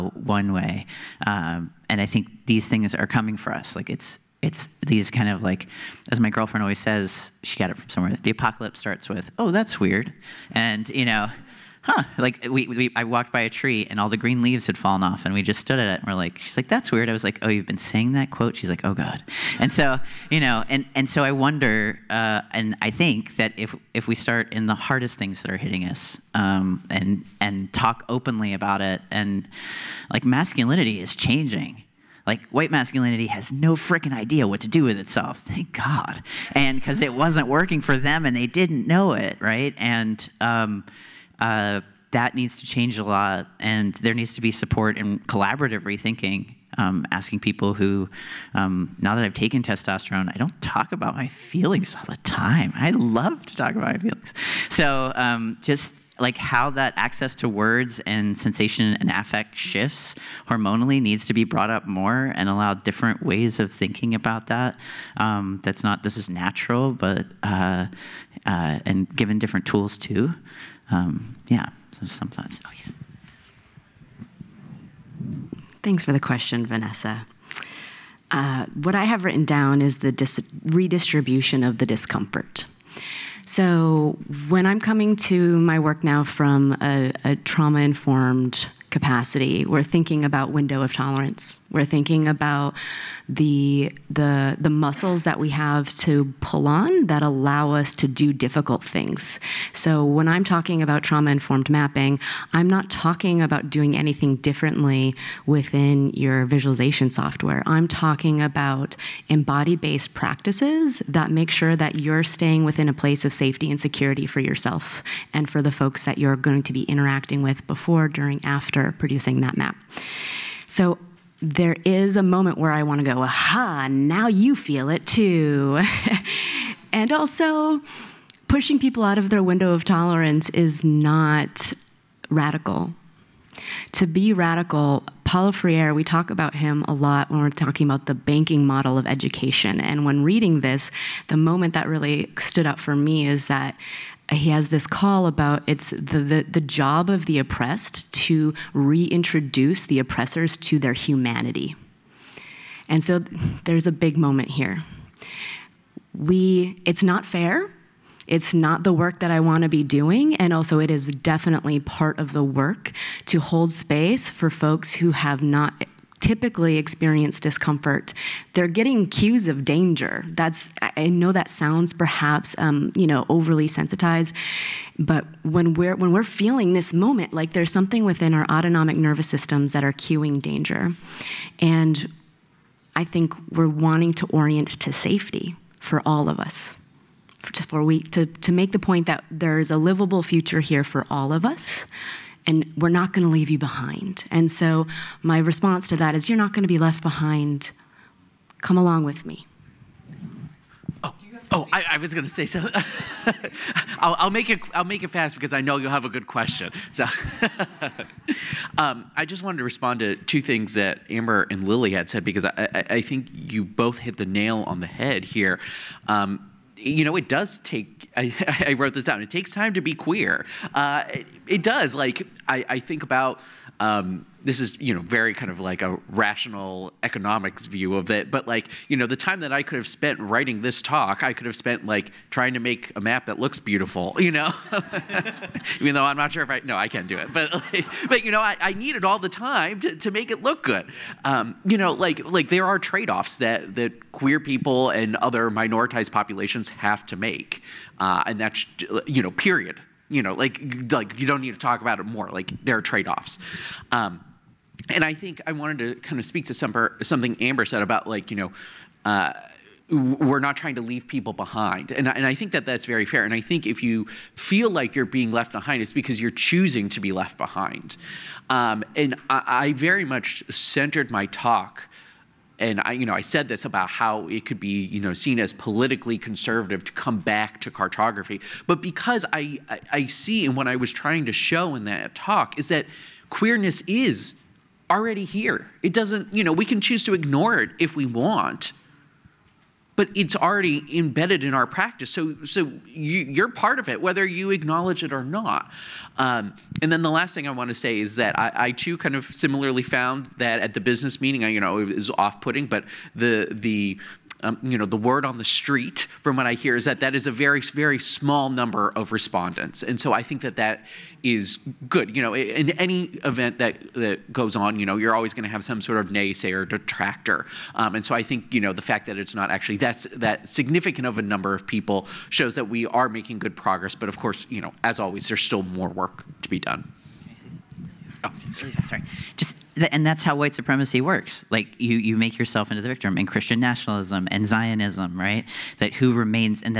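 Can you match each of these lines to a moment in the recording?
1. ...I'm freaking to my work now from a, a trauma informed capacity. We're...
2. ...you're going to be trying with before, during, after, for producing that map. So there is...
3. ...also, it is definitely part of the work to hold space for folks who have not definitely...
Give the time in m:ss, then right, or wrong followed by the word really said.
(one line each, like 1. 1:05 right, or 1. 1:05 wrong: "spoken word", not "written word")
1. 1:24 wrong: "coming", not "freaking"
2. 1:56 wrong: "interacting", not "trying"
3. 2:40 wrong: "typically", not "definitely".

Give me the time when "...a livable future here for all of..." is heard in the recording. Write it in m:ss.
3:09.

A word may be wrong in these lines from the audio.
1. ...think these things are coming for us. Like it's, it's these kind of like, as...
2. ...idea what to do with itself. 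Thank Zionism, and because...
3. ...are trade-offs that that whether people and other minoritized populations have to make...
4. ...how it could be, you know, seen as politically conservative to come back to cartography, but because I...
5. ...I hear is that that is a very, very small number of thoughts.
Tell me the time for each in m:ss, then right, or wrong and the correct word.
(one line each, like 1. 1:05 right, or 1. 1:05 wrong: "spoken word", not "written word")
1. 0:02 right
2. 0:34 wrong: "God", not "Zionism"
3. 4:02 wrong: "queer", not "whether"
4. 4:33 right
5. 5:06 wrong: "respondents", not "thoughts".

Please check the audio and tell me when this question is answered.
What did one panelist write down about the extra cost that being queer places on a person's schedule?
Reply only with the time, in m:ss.
3:39.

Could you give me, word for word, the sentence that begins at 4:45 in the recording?
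It doesn't, you know, we can choose to ignore it if we want, but it's already embedded in our practice.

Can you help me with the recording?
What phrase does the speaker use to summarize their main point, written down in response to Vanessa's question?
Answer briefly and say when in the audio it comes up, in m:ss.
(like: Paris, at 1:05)
redistribution of the discomfort, at 1:20.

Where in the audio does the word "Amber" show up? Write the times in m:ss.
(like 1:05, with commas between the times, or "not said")
3:31, 4:17.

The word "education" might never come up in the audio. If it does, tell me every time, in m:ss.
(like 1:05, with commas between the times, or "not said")
2:19.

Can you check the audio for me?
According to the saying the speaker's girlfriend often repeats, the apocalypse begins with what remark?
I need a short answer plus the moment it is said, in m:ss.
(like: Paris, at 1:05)
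Oh, that's weird, at 0:09.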